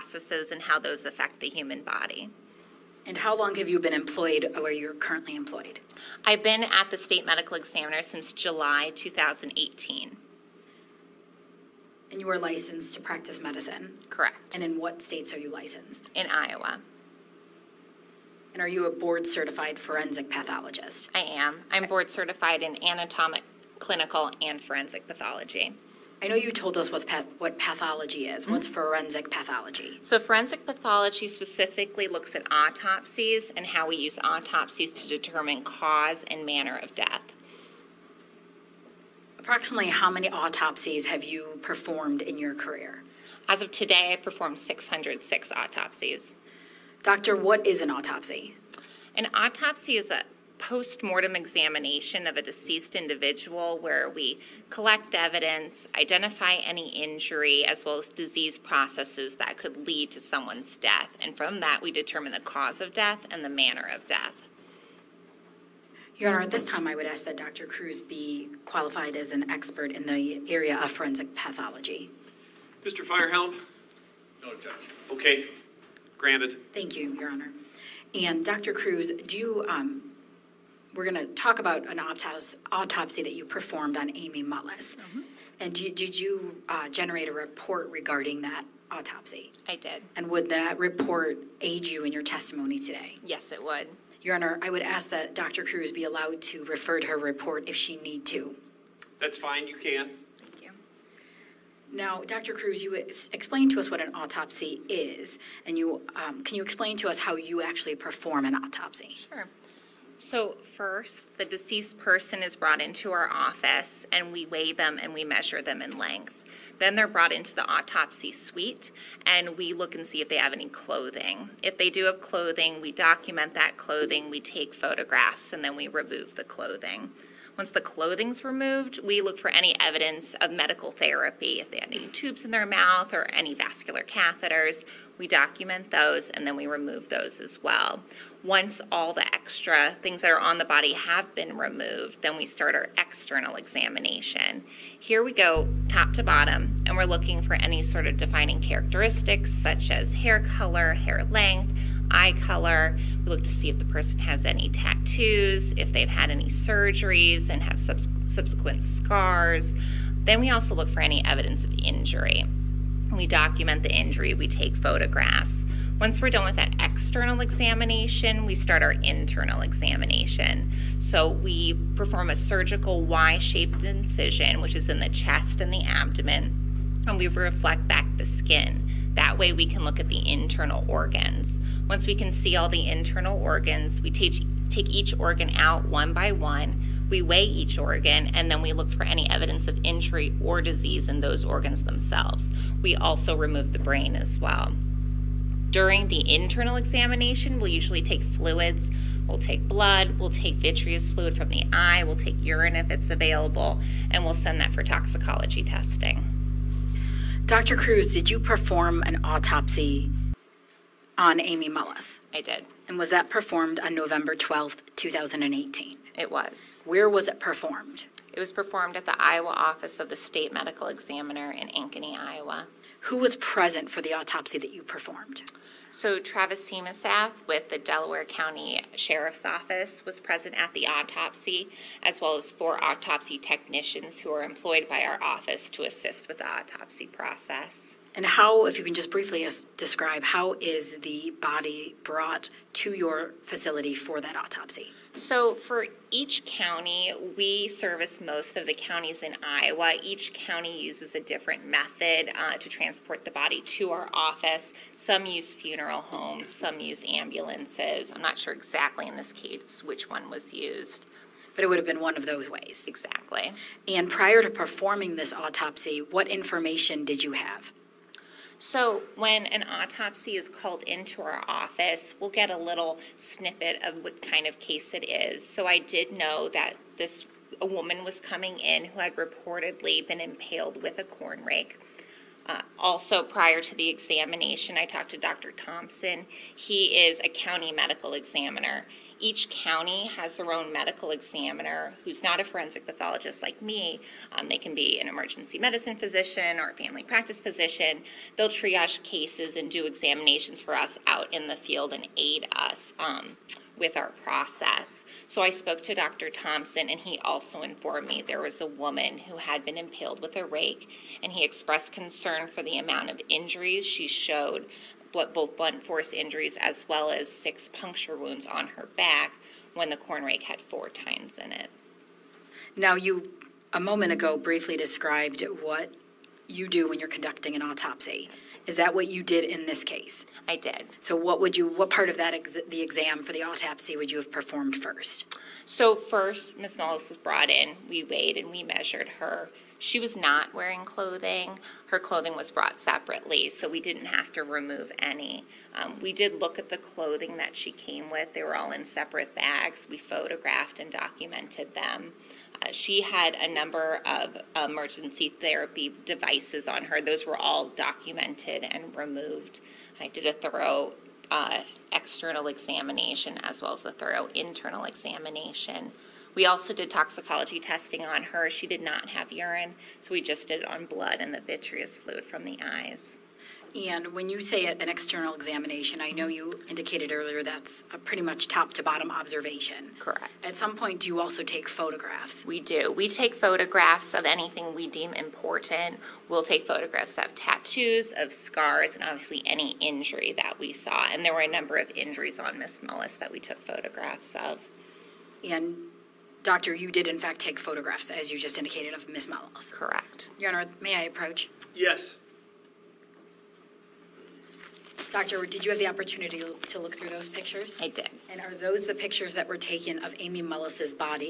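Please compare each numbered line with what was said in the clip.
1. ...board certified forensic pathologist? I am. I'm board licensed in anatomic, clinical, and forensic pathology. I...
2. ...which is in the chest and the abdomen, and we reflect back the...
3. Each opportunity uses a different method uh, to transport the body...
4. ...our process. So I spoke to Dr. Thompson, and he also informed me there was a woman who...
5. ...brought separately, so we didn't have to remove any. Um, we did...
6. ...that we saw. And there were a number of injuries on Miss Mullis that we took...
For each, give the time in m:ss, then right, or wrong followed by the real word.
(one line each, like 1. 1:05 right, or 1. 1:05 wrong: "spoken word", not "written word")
1. 0:18 wrong: "certified", not "licensed"
2. 2:54 right
3. 4:10 wrong: "county", not "opportunity"
4. 5:03 right
5. 5:42 right
6. 6:30 right.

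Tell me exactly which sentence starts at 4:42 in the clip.
Uh, also, prior to the examination, I talked to Dr.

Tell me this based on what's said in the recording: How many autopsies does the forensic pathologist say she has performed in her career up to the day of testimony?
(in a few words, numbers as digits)
606.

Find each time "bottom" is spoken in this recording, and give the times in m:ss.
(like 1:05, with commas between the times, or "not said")
2:26, 6:18.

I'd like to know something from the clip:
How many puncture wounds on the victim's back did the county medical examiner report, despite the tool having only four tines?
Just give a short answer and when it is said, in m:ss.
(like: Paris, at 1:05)
6, at 5:17.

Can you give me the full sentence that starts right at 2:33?
We look to see if the person has any tattoos, if they've had any surgeries and have subs subsequent scars.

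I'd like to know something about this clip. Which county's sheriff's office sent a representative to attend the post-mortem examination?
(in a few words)
Delaware County.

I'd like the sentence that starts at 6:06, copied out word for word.
We also did toxicology testing on her.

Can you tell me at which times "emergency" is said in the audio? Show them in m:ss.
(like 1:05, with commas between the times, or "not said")
4:55, 5:54.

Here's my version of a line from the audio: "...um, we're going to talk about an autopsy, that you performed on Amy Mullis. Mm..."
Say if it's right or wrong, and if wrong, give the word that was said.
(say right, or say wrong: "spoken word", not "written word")
right.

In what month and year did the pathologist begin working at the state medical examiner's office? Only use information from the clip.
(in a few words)
July 2018.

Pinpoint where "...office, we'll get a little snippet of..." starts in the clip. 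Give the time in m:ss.
4:31.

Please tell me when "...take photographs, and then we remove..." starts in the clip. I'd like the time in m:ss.
2:04.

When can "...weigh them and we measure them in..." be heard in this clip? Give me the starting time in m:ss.
1:54.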